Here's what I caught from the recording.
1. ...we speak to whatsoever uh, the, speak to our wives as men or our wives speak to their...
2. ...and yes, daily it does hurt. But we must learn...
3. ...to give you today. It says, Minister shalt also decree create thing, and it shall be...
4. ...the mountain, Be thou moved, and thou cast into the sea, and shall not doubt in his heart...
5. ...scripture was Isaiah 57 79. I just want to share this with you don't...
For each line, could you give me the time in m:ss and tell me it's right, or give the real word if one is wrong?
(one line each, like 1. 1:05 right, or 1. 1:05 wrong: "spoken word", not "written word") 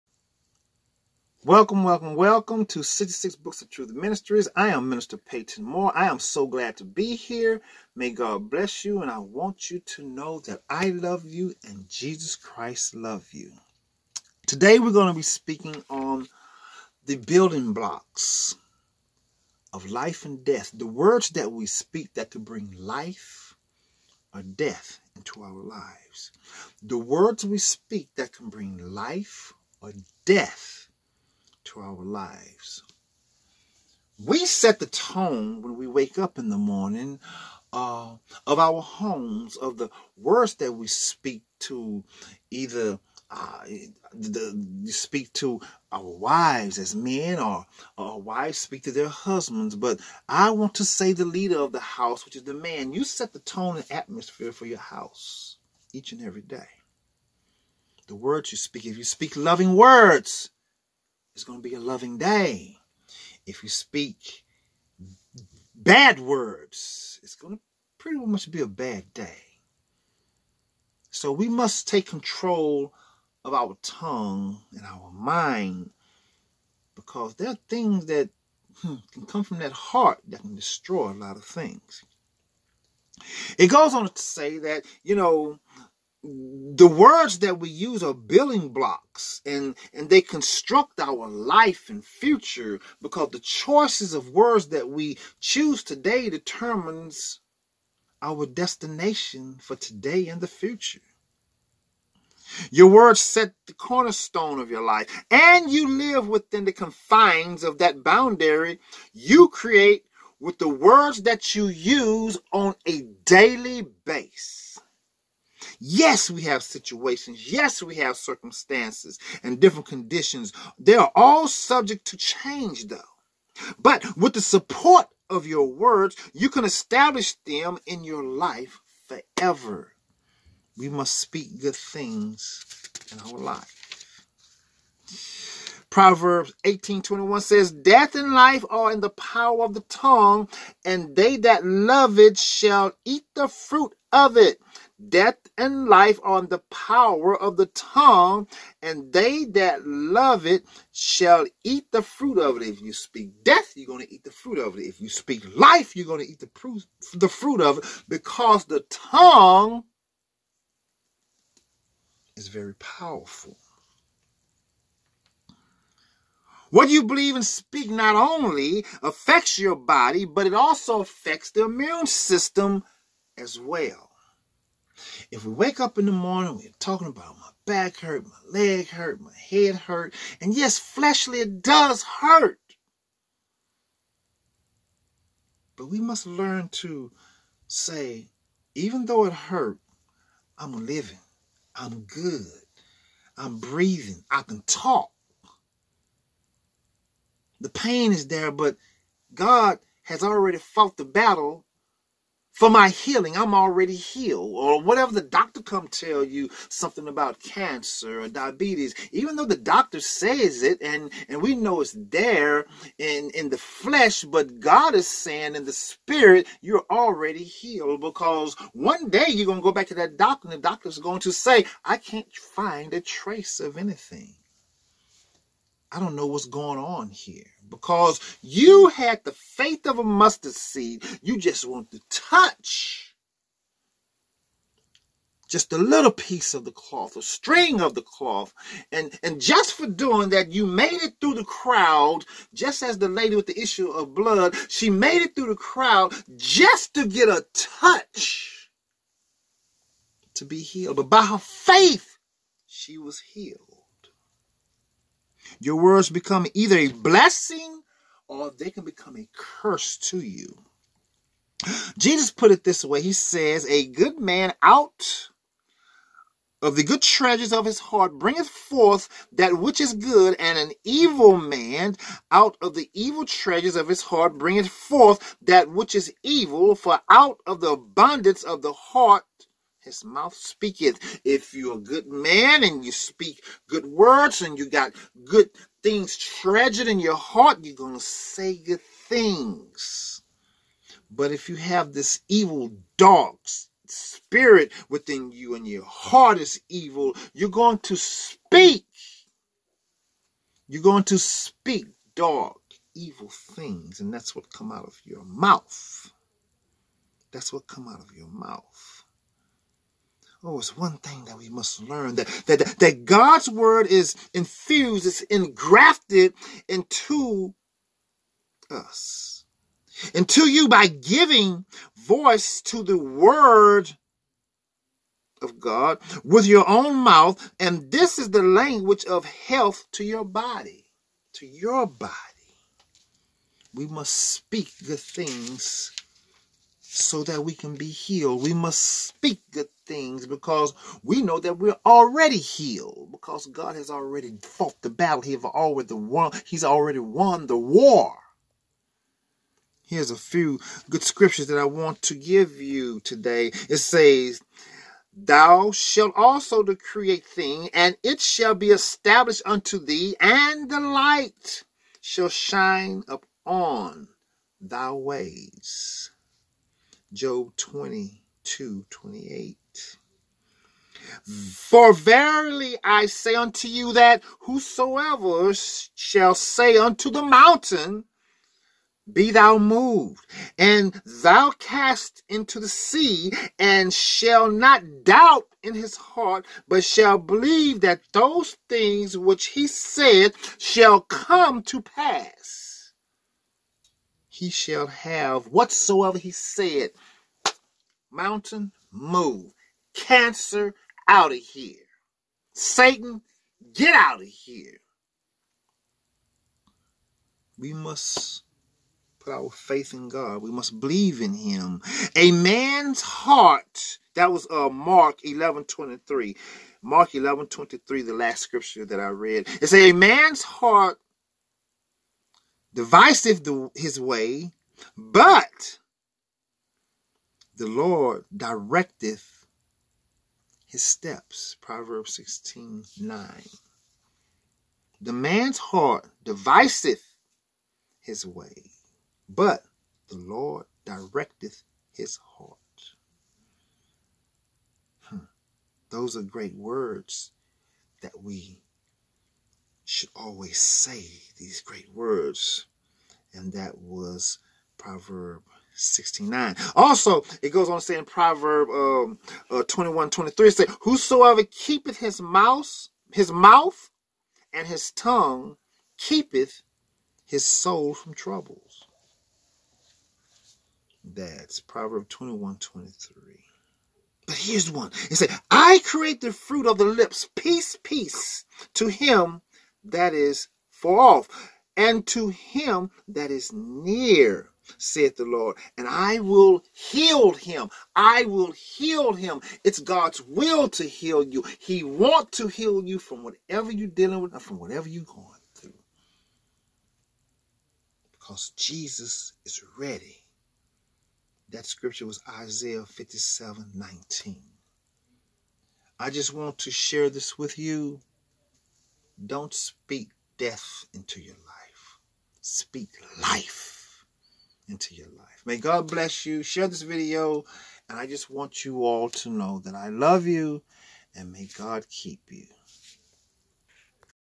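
1. 0:40 wrong: "either", not "whatsoever"
2. 3:00 wrong: "fleshly", not "daily"
3. 5:52 wrong: "Thou", not "Minister"
4. 6:17 right
5. 8:21 wrong: "19", not "79".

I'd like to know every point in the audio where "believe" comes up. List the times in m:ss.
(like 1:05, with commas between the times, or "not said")
2:47, 6:27, 6:50.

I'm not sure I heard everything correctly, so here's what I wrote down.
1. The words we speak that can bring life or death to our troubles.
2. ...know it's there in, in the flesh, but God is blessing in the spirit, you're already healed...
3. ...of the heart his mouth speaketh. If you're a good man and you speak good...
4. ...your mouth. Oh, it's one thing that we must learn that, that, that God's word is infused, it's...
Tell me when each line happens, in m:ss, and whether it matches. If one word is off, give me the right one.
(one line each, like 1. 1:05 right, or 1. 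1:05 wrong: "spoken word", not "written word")
1. 0:26 wrong: "lives", not "troubles"
2. 3:31 wrong: "saying", not "blessing"
3. 4:38 right
4. 5:08 right.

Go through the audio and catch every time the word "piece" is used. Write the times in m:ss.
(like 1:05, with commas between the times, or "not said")
3:56.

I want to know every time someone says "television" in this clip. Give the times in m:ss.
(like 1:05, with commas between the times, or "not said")
not said.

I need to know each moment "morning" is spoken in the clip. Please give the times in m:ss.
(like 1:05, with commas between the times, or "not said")
0:36, 2:56.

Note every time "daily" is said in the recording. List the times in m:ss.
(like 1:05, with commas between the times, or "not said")
1:53.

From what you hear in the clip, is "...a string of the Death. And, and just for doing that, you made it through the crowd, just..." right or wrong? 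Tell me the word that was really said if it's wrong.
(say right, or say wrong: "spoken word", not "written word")
wrong: "cloth", not "Death".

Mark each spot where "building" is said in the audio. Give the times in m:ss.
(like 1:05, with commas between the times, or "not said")
0:17, 1:28.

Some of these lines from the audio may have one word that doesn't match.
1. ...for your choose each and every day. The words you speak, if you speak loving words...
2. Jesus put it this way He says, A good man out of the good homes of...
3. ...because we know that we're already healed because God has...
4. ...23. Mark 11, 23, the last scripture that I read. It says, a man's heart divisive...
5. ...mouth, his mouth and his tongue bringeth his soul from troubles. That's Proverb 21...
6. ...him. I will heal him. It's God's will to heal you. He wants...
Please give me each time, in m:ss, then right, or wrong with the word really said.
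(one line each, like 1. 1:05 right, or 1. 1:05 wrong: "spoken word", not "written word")
1. 0:54 wrong: "house", not "choose"
2. 4:21 wrong: "treasures", not "homes"
3. 5:40 right
4. 6:55 right
5. 7:42 wrong: "keepeth", not "bringeth"
6. 8:07 right.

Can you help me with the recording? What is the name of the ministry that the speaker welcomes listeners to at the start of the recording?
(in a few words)
66 Books of Truth Ministries.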